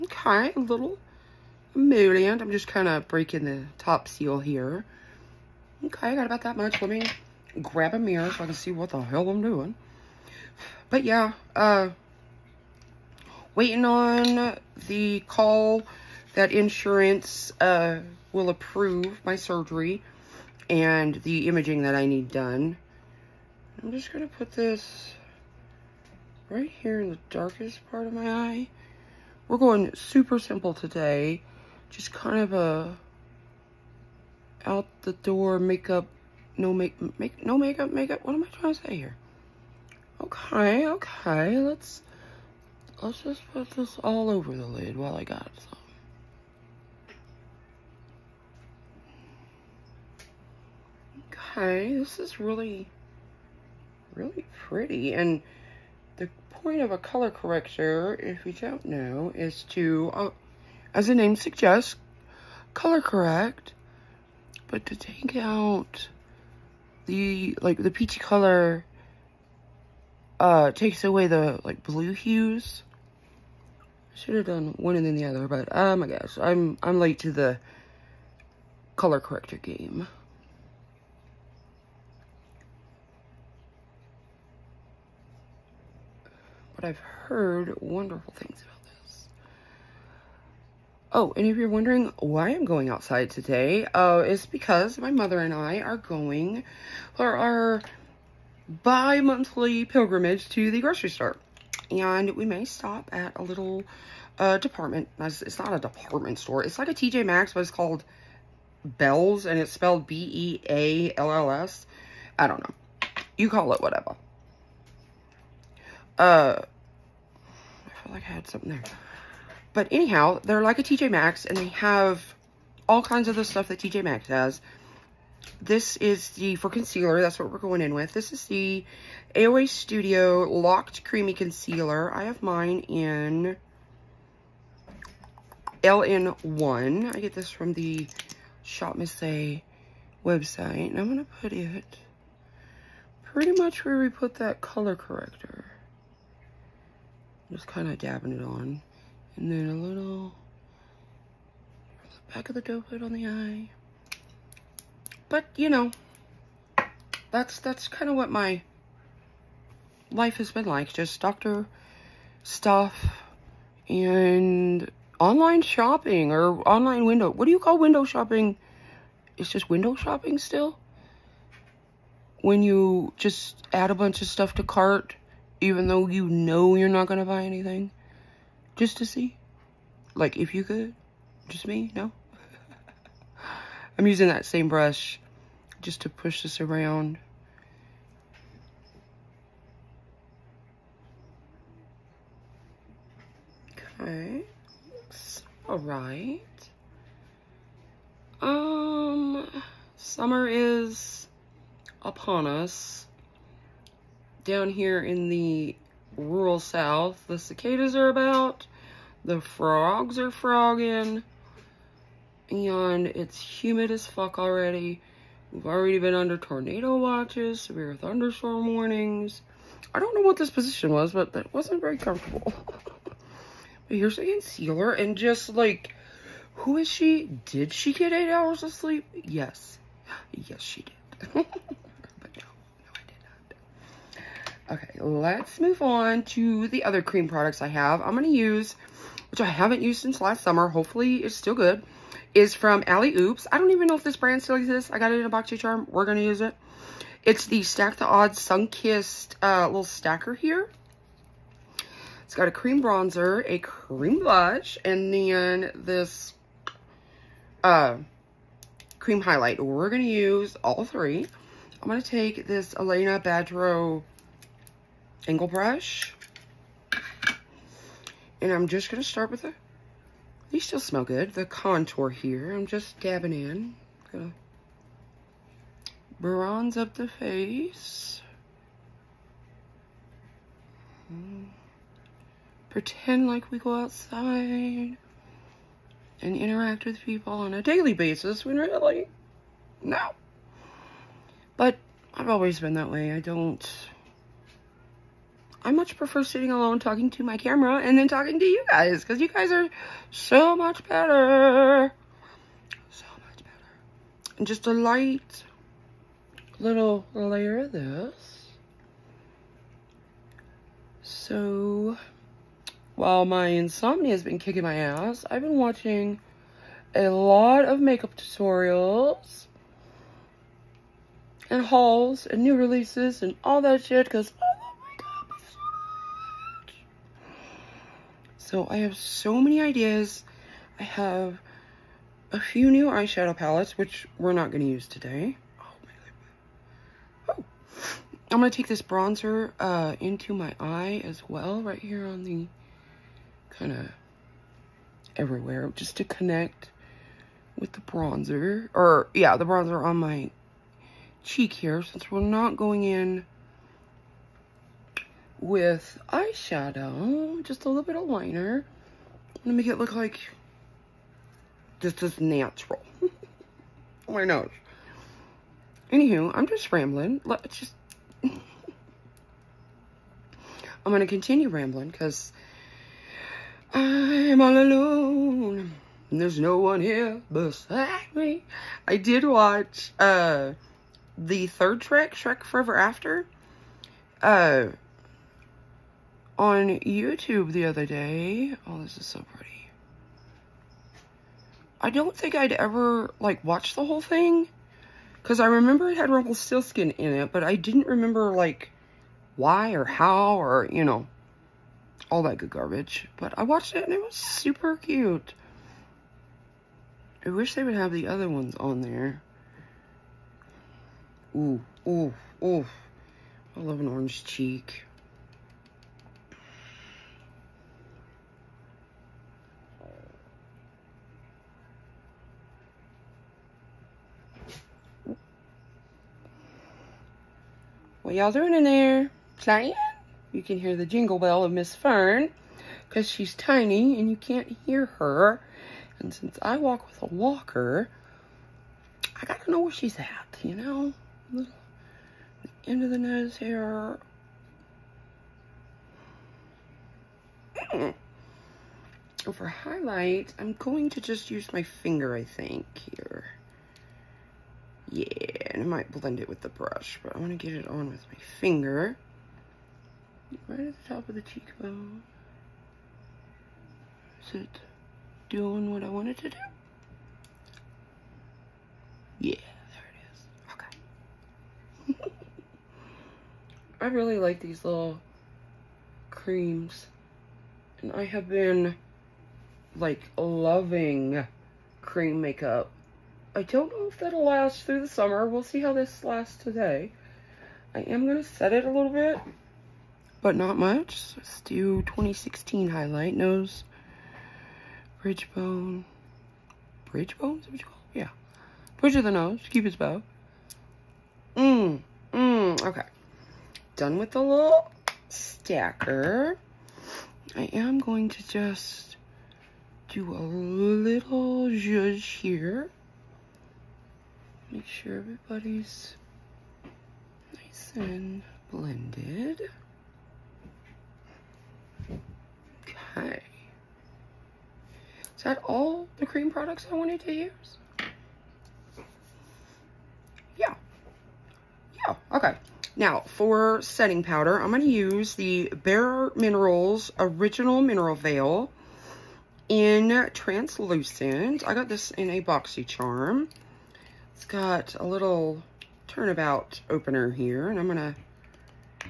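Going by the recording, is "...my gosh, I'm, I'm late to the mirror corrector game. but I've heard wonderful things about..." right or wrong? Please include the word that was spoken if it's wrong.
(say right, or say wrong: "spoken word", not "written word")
wrong: "color", not "mirror".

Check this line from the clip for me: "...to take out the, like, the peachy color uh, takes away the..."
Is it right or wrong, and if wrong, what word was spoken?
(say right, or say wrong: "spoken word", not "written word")
right.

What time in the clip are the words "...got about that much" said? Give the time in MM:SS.
00:06.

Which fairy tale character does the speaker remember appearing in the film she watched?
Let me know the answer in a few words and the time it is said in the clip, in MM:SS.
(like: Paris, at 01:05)
Rumpelstiltskin, at 06:36.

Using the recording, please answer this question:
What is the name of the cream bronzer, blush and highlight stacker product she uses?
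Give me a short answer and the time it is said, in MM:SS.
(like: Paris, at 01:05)
Stack the Odds Sunkissed, at 04:07.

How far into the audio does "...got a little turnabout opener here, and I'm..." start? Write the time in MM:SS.
09:04.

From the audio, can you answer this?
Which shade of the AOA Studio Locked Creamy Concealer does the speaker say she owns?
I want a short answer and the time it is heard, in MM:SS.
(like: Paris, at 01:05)
LN1, at 02:15.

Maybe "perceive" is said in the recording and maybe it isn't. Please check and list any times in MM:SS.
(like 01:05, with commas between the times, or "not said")
not said.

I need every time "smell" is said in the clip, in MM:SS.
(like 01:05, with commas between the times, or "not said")
04:30.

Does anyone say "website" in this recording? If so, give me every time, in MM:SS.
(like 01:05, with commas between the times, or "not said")
02:20.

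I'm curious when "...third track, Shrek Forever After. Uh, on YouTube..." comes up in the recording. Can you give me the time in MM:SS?
06:21.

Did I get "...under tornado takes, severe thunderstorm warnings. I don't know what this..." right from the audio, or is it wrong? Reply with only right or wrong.
wrong.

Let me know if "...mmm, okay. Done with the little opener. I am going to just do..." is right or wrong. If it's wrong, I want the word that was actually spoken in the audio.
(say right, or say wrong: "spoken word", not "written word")
wrong: "stacker", not "opener".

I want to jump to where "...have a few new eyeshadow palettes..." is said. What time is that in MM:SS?
05:30.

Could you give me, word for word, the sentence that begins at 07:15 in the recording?
And since I walk with a walker, I gotta know where she's at, you know?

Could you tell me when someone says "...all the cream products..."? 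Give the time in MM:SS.
08:45.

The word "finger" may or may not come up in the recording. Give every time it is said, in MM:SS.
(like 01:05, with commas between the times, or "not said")
07:31, 07:38.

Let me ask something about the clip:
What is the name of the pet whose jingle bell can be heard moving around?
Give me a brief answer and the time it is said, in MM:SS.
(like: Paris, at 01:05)
Fern, at 07:11.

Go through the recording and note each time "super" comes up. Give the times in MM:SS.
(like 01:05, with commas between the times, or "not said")
00:29, 06:44.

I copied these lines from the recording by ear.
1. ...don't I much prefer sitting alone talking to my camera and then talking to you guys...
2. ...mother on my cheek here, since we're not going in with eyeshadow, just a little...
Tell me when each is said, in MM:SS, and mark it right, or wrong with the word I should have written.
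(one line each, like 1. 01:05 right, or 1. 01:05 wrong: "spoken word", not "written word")
1. 04:53 right
2. 05:49 wrong: "bronzer", not "mother".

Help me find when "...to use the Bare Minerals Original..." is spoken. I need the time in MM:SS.
08:54.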